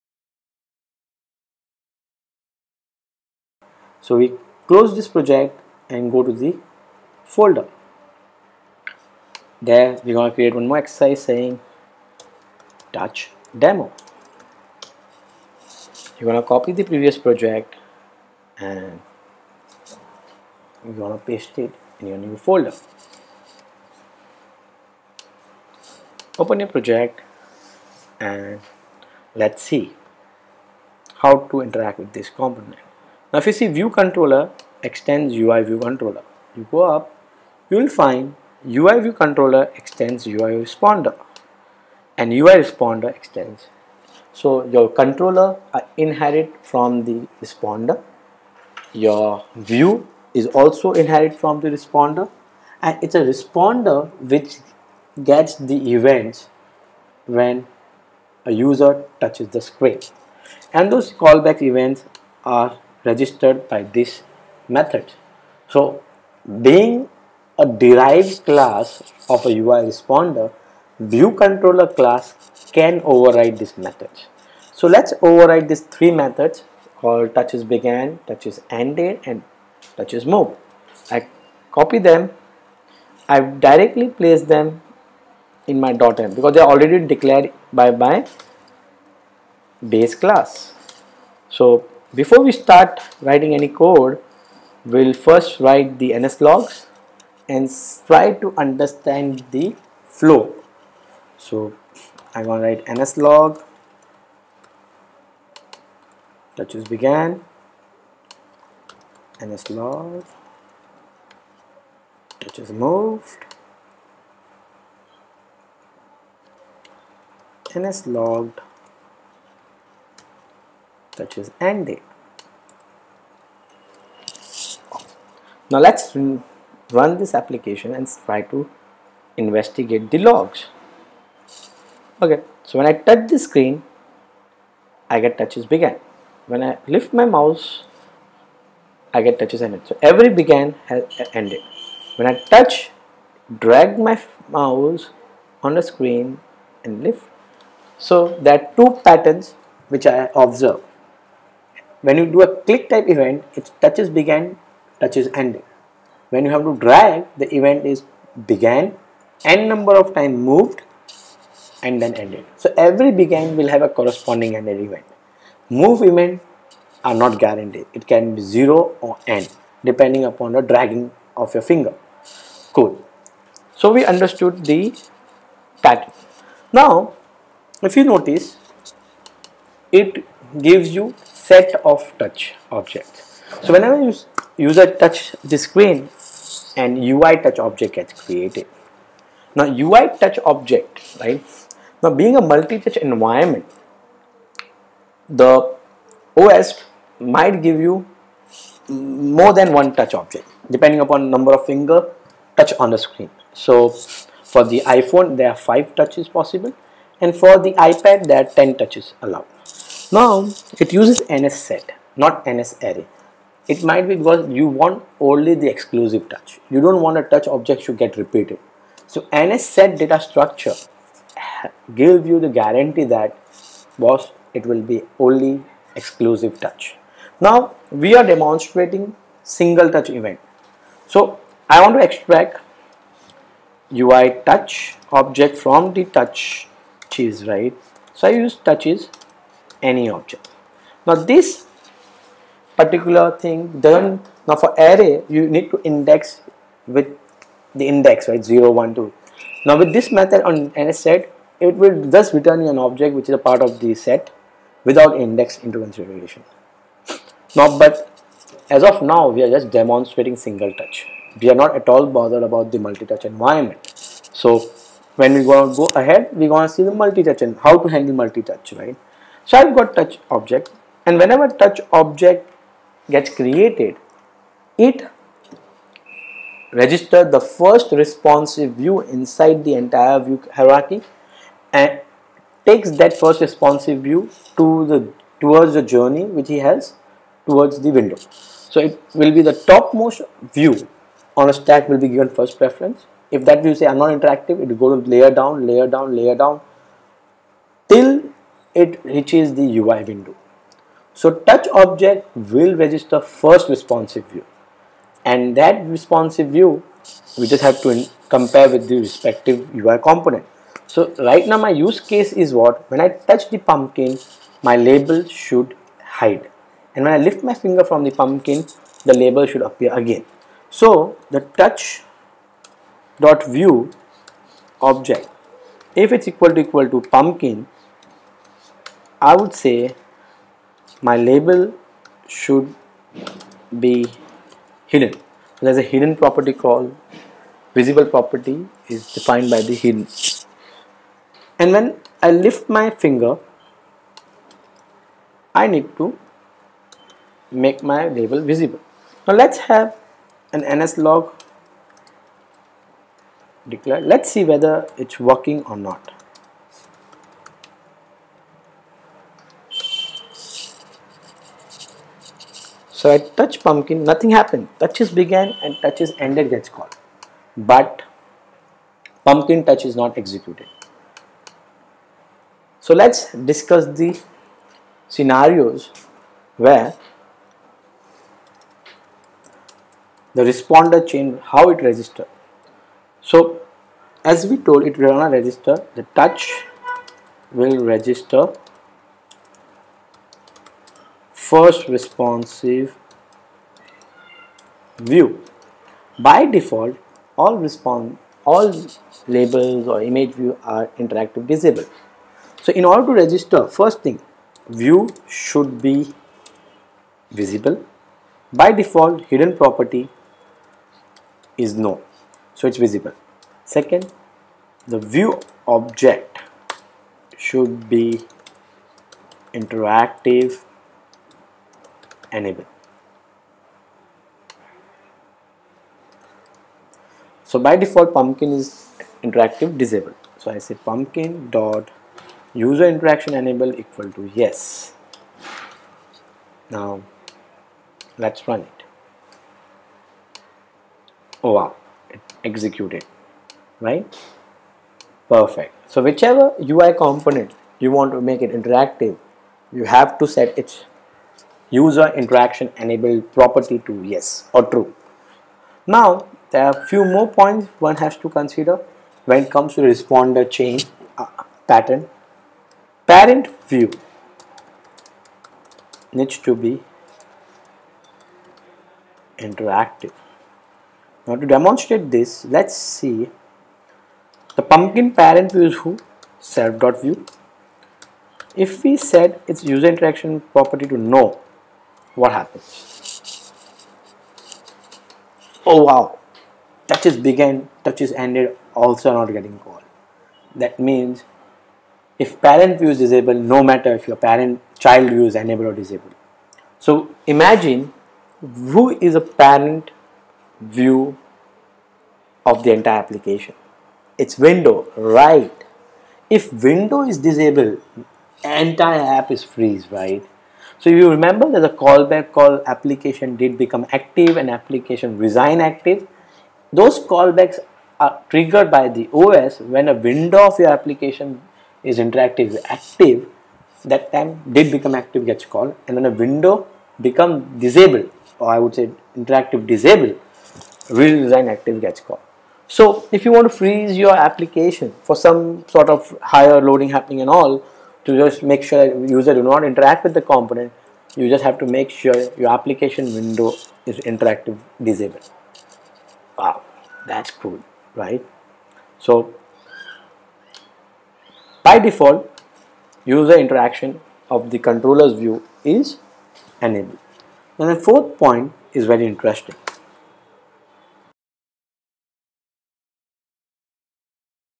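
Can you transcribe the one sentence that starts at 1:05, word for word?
So being a derived class of a UI responder, view controller class can override this method.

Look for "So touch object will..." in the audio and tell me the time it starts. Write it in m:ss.
5:01.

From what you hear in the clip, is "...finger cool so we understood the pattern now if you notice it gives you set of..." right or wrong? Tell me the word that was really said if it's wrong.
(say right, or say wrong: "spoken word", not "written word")
right.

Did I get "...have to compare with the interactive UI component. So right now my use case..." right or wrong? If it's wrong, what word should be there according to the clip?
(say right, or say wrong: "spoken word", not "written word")
wrong: "respective", not "interactive".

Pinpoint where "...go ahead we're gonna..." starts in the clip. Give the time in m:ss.
4:25.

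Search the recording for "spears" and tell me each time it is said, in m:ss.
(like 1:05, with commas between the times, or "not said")
not said.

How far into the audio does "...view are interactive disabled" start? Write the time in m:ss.
6:40.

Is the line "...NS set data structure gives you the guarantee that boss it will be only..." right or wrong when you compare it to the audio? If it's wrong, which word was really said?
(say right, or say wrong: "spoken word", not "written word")
right.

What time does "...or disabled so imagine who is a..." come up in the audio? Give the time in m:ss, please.
8:15.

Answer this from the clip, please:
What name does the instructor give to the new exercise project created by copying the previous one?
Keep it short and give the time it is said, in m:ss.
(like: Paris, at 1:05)
touch demo, at 0:12.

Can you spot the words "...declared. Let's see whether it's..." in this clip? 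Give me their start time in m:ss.
5:53.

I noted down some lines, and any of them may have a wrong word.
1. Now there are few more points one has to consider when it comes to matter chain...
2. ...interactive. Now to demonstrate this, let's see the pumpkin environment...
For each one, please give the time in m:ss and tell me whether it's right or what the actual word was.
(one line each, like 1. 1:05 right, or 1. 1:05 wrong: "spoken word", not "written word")
1. 7:35 wrong: "responder", not "matter"
2. 7:49 wrong: "parent", not "environment".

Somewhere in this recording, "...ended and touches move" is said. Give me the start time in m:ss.
1:18.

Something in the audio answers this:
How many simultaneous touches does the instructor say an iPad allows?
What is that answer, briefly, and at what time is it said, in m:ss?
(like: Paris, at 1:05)
10, at 3:28.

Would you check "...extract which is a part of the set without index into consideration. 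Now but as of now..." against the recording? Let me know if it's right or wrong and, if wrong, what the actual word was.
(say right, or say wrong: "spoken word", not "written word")
wrong: "object", not "extract".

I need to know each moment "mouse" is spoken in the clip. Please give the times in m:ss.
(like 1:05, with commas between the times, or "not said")
2:17, 2:24.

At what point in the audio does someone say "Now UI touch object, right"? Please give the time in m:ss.
3:09.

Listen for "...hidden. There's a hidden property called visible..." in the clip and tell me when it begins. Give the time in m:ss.
5:34.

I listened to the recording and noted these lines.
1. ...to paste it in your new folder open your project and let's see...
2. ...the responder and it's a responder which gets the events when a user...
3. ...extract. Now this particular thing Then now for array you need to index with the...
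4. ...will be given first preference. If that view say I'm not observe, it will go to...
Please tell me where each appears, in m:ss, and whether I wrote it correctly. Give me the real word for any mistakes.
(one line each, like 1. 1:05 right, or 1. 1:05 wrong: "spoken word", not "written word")
1. 0:21 right
2. 0:51 right
3. 4:00 wrong: "object", not "extract"
4. 4:51 wrong: "interactive", not "observe".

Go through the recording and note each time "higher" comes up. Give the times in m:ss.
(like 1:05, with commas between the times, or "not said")
8:56.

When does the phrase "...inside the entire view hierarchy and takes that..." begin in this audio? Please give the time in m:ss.
4:39.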